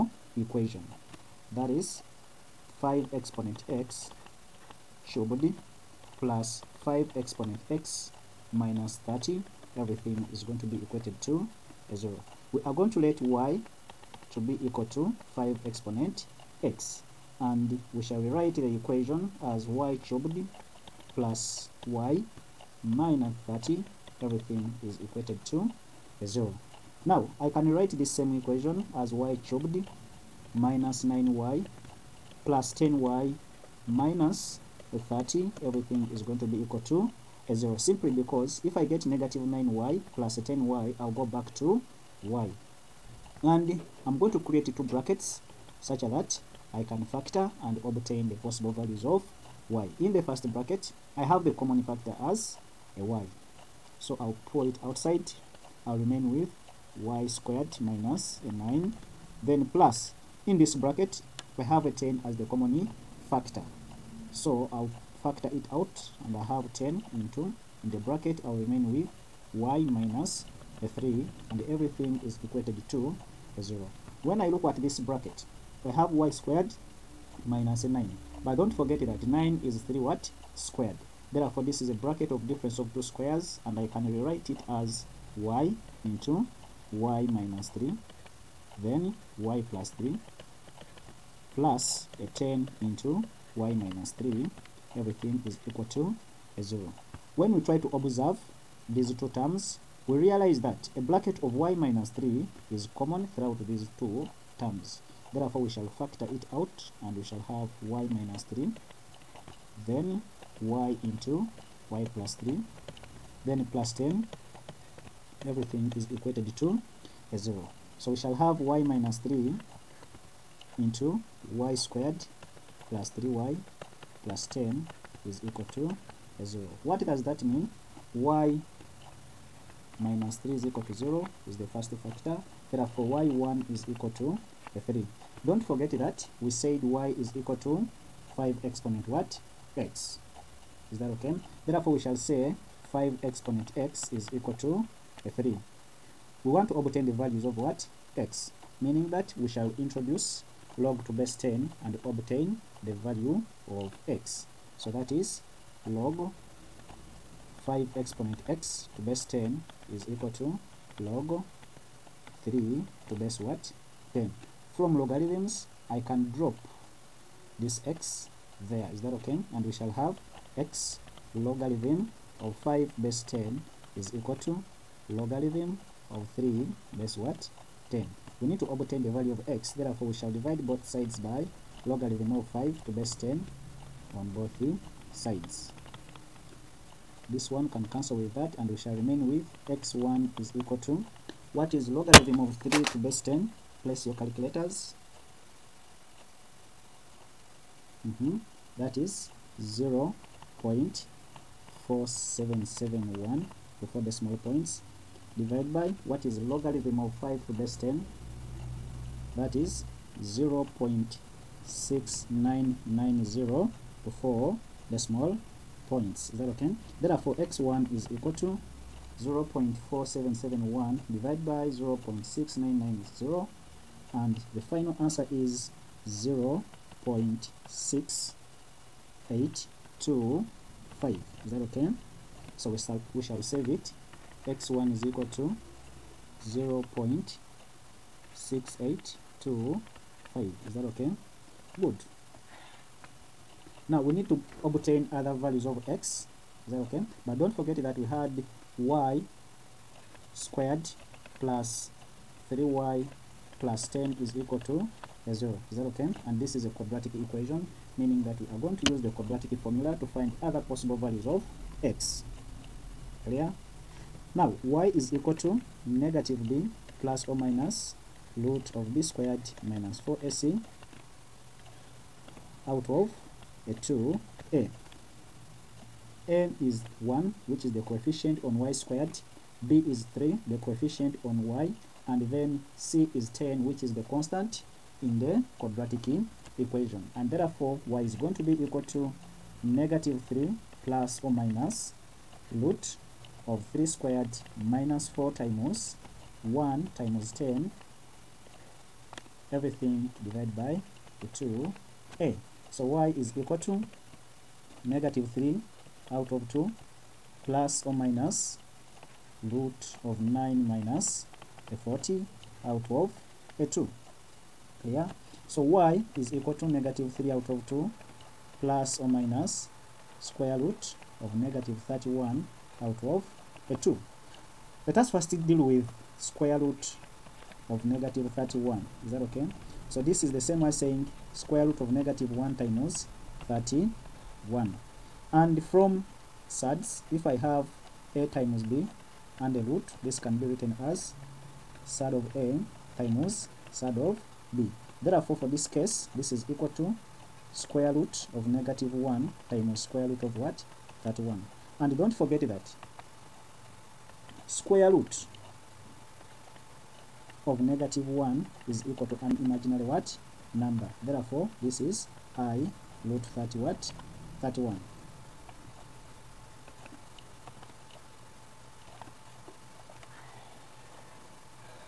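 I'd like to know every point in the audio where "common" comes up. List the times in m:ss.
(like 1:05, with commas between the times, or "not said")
0:51, 1:02, 1:42.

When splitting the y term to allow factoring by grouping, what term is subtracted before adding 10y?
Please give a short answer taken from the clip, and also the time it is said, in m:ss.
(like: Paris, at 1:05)
9y, at 0:30.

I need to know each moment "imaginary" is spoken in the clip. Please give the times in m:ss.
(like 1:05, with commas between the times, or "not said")
5:59.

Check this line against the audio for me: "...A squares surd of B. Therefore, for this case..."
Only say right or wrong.
wrong.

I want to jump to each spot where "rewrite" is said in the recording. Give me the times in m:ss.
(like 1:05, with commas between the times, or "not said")
0:18, 1:24.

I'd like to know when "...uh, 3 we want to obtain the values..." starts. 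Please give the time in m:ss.
2:25.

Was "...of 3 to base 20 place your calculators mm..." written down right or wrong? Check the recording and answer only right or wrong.
wrong.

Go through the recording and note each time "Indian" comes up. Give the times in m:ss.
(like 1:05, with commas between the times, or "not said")
not said.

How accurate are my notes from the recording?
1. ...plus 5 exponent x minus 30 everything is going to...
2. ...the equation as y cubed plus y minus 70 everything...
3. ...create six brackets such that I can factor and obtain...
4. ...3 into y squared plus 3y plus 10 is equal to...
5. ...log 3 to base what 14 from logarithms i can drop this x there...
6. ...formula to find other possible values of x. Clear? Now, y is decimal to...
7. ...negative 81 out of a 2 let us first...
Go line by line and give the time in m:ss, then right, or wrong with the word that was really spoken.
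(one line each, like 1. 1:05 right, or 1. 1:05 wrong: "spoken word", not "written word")
1. 0:06 right
2. 0:18 wrong: "30", not "70"
3. 0:44 wrong: "two", not "six"
4. 1:59 right
5. 2:41 wrong: "10", not "14"
6. 4:19 wrong: "equal", not "decimal"
7. 5:21 wrong: "31", not "81".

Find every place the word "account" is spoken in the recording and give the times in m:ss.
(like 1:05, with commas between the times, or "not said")
not said.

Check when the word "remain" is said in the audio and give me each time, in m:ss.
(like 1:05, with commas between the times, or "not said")
0:55, 1:08, 3:08.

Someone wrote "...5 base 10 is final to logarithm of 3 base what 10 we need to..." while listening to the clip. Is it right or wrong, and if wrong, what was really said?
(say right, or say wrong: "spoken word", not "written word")
wrong: "equal", not "final".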